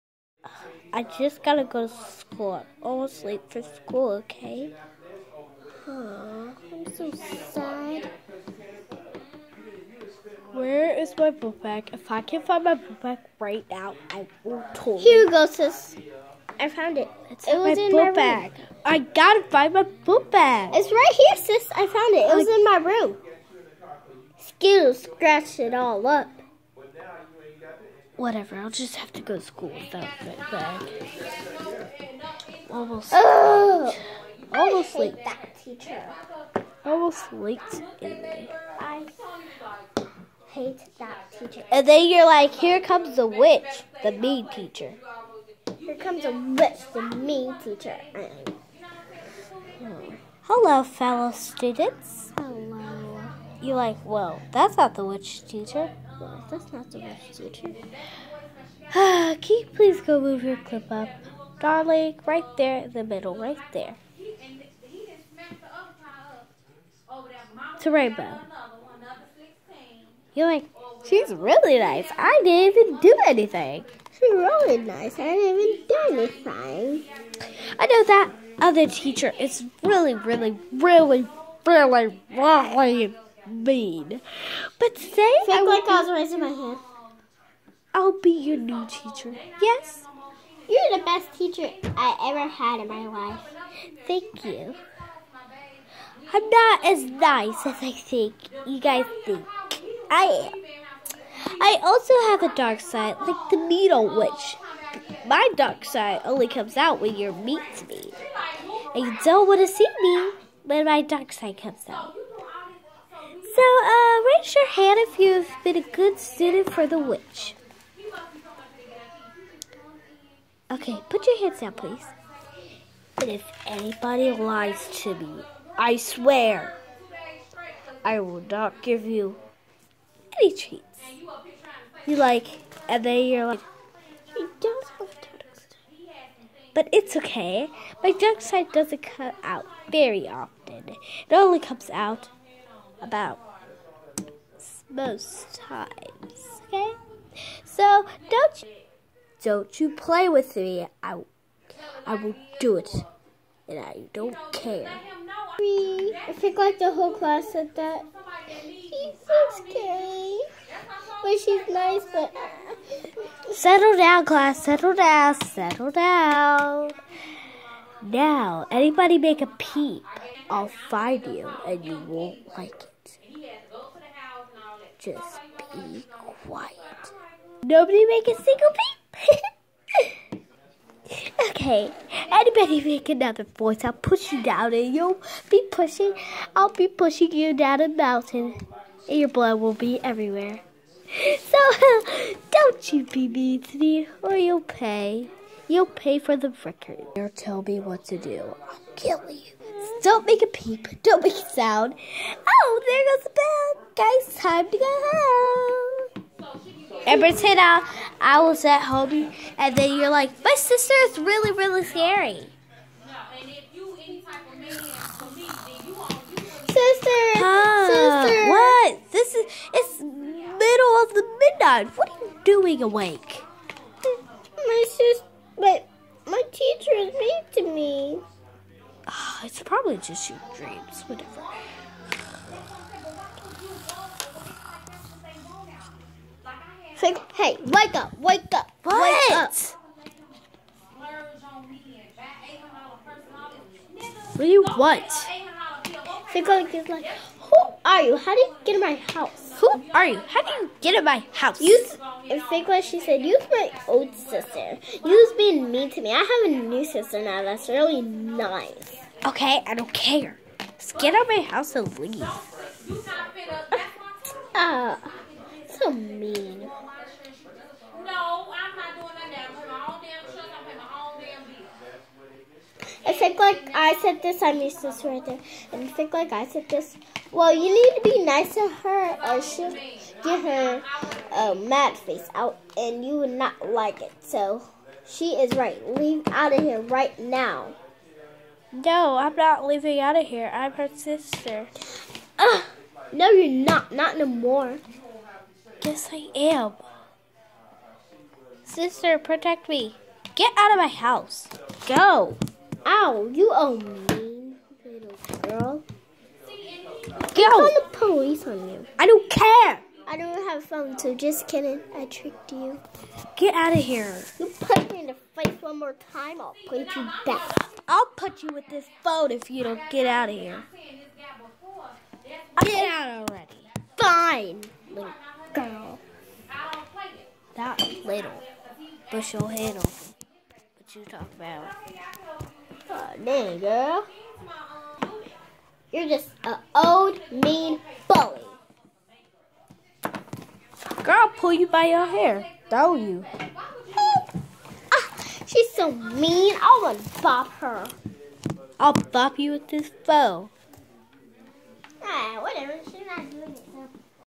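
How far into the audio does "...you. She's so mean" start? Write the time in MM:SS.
05:42.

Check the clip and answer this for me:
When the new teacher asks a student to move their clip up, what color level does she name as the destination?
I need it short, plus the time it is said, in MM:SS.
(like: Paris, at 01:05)
Rainbow, at 01:07.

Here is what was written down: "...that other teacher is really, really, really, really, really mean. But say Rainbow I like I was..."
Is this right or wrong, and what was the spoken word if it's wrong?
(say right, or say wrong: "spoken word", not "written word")
wrong: "Fake", not "Rainbow".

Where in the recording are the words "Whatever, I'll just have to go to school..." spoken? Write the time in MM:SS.
00:28.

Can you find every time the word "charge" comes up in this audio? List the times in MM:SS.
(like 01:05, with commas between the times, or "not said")
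not said.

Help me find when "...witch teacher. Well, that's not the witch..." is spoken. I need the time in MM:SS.
00:55.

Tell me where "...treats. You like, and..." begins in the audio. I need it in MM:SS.
02:10.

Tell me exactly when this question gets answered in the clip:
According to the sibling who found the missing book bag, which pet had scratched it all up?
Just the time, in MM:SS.
00:24.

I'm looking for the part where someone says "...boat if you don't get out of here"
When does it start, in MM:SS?
05:19.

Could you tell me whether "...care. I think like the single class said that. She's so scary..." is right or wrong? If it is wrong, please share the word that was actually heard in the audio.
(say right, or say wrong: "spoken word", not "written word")
wrong: "whole", not "single".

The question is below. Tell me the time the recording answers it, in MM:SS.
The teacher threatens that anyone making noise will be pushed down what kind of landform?
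03:07.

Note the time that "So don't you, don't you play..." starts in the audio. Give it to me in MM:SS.
02:27.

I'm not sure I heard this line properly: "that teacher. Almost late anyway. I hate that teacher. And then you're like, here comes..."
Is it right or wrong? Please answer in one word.
right.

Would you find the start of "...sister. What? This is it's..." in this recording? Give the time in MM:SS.
03:37.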